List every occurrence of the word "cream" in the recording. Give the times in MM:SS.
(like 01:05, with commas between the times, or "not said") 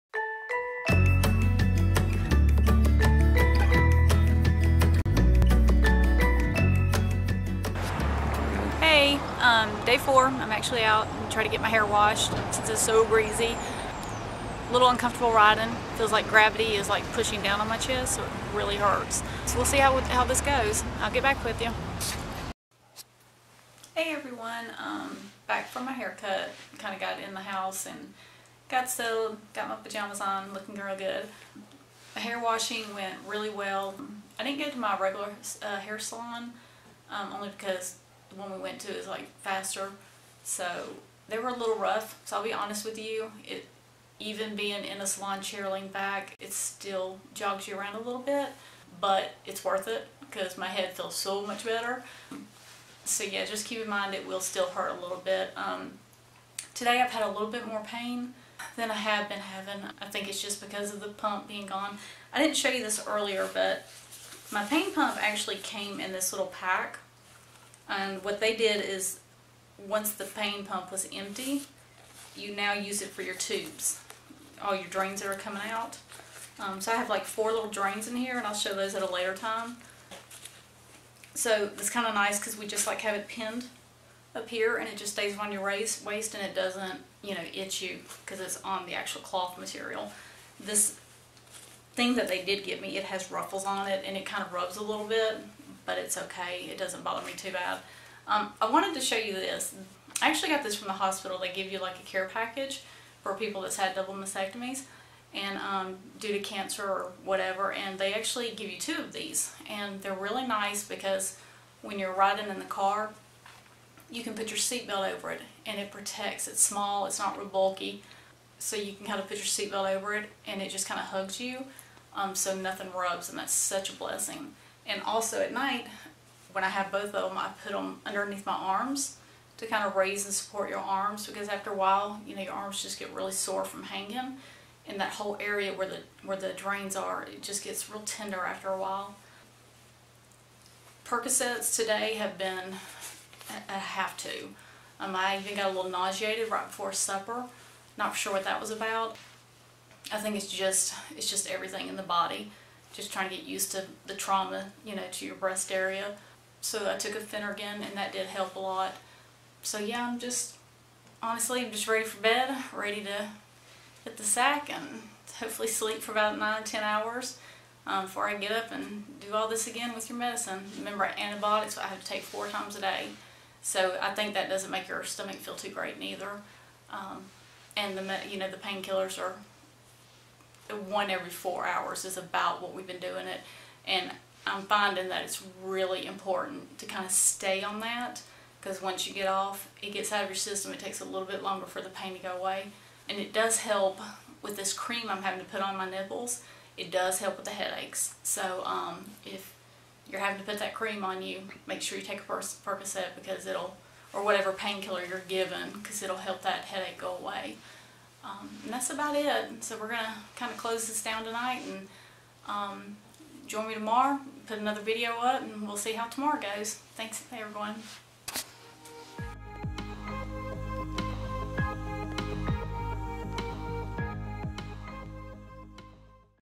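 03:14, 03:20.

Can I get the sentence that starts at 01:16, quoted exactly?
Um, so I have like four little drains in here and I'll show those at a later time.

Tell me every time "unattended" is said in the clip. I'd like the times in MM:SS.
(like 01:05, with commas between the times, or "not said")
not said.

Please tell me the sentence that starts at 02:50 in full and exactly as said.
Remember, antibiotics I have to take four times a day.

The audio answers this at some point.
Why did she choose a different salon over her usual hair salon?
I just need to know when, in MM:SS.
00:39.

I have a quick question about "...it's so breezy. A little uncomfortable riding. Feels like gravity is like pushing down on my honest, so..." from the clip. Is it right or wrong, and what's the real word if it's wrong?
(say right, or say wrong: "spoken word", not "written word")
wrong: "chest", not "honest".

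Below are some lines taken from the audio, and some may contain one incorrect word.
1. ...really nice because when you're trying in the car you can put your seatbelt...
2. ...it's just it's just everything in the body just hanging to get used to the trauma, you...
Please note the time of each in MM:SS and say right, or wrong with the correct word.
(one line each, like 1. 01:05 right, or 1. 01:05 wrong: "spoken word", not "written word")
1. 01:50 wrong: "riding", not "trying"
2. 02:30 wrong: "trying", not "hanging".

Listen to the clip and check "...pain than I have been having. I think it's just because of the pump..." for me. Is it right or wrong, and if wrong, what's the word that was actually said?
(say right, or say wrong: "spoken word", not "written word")
right.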